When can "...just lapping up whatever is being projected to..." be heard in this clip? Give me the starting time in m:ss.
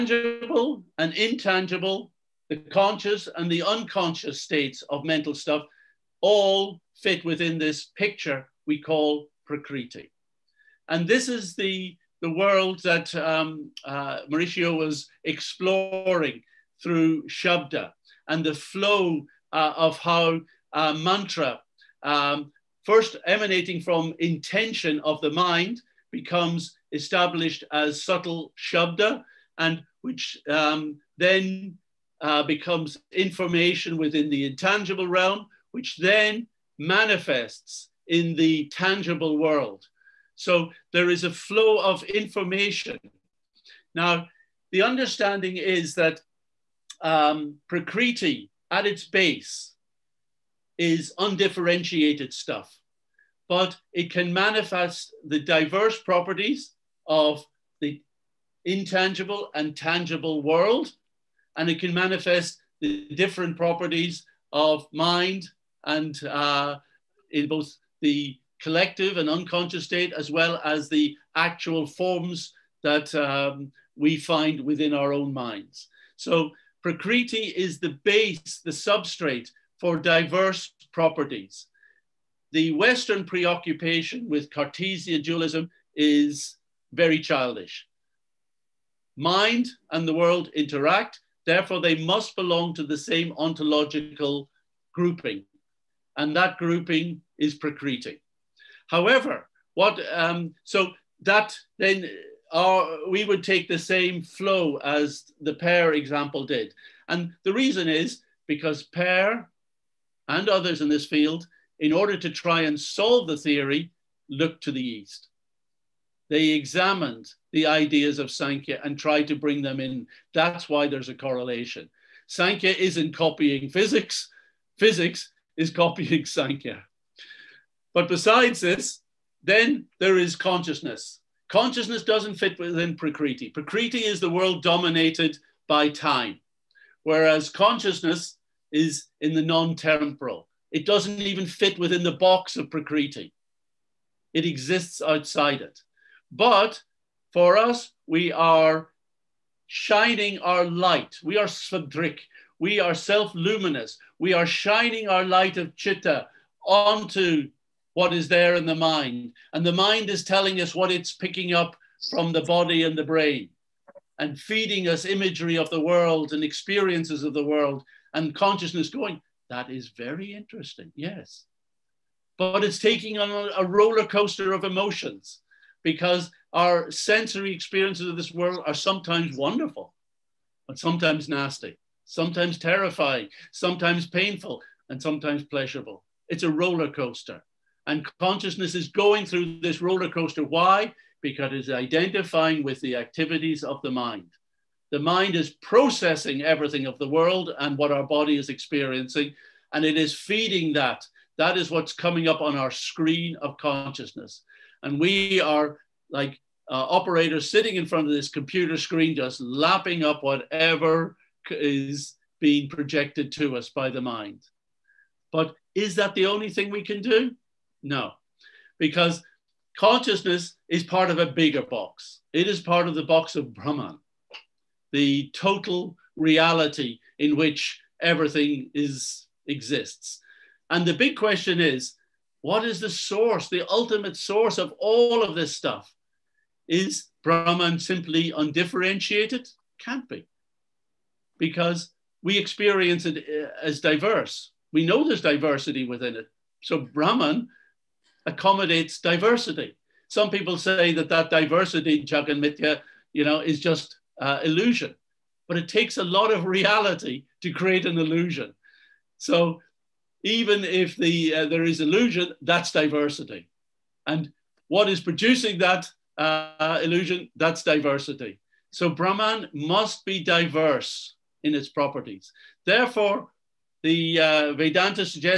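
3:29.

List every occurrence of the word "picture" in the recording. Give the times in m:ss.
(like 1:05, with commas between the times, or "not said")
0:07.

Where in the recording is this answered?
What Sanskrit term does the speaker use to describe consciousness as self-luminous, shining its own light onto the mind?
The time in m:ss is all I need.
2:31.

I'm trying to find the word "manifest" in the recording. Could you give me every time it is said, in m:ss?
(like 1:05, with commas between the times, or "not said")
0:36, 0:54, 1:01.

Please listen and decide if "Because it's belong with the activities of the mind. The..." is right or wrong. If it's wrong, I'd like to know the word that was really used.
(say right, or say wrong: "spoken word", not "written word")
wrong: "identifying", not "belong".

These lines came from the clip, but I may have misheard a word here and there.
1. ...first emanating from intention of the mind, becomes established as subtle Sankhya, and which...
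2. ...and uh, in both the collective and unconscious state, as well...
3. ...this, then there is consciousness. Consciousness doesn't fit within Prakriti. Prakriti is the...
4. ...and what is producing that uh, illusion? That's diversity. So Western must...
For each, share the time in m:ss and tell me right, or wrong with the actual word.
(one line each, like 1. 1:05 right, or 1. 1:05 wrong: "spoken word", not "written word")
1. 0:22 wrong: "Shabda", not "Sankhya"
2. 1:05 right
3. 2:08 right
4. 4:24 wrong: "Brahman", not "Western".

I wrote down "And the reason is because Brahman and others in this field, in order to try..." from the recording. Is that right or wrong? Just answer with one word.
wrong.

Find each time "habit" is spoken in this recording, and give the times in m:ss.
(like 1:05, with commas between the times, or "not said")
not said.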